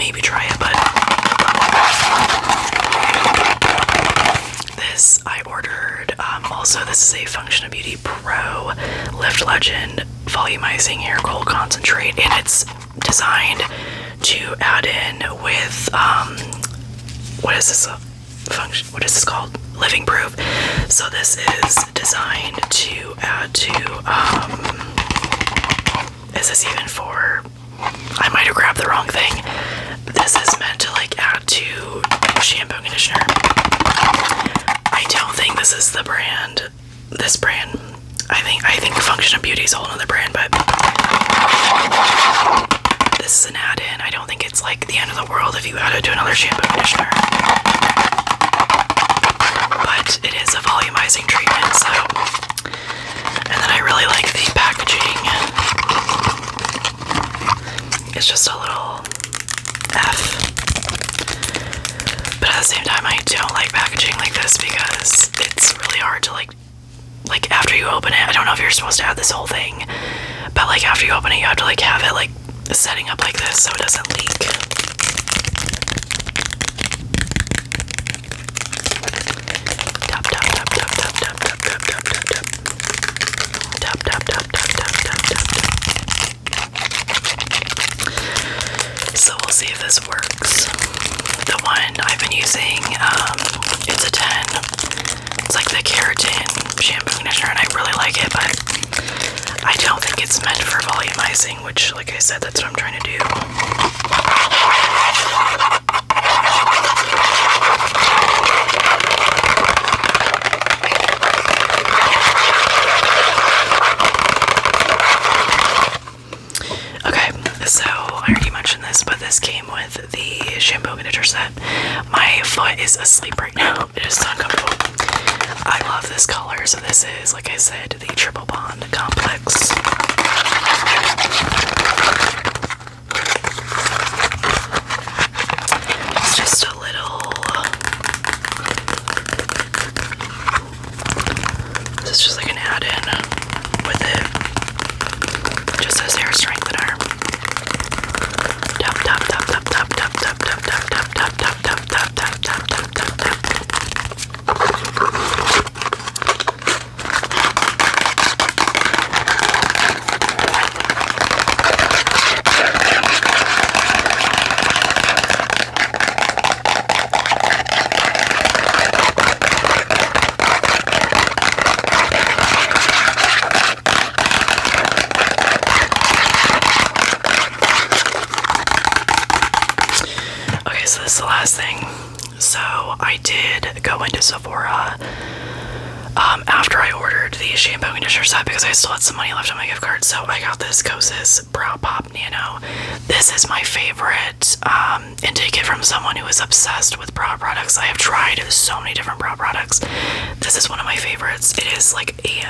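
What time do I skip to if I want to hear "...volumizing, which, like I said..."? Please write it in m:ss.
1:40.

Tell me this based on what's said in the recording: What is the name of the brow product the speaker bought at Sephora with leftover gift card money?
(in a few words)
Kosas Brow Pop Nano.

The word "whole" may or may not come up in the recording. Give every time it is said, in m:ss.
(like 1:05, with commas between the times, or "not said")
0:39, 1:09.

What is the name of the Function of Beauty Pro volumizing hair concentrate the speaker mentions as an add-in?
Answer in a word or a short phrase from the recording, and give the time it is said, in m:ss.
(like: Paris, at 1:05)
Lift Legend, at 0:09.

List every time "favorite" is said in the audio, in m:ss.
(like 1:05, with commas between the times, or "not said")
3:13, 3:20.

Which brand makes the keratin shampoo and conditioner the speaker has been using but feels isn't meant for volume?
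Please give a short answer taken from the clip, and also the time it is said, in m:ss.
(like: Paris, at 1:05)
It's a 10, at 1:33.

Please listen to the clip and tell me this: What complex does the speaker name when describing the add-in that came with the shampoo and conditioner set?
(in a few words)
Triple Bond Complex.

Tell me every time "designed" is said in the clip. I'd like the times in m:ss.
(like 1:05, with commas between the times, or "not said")
0:13, 0:21.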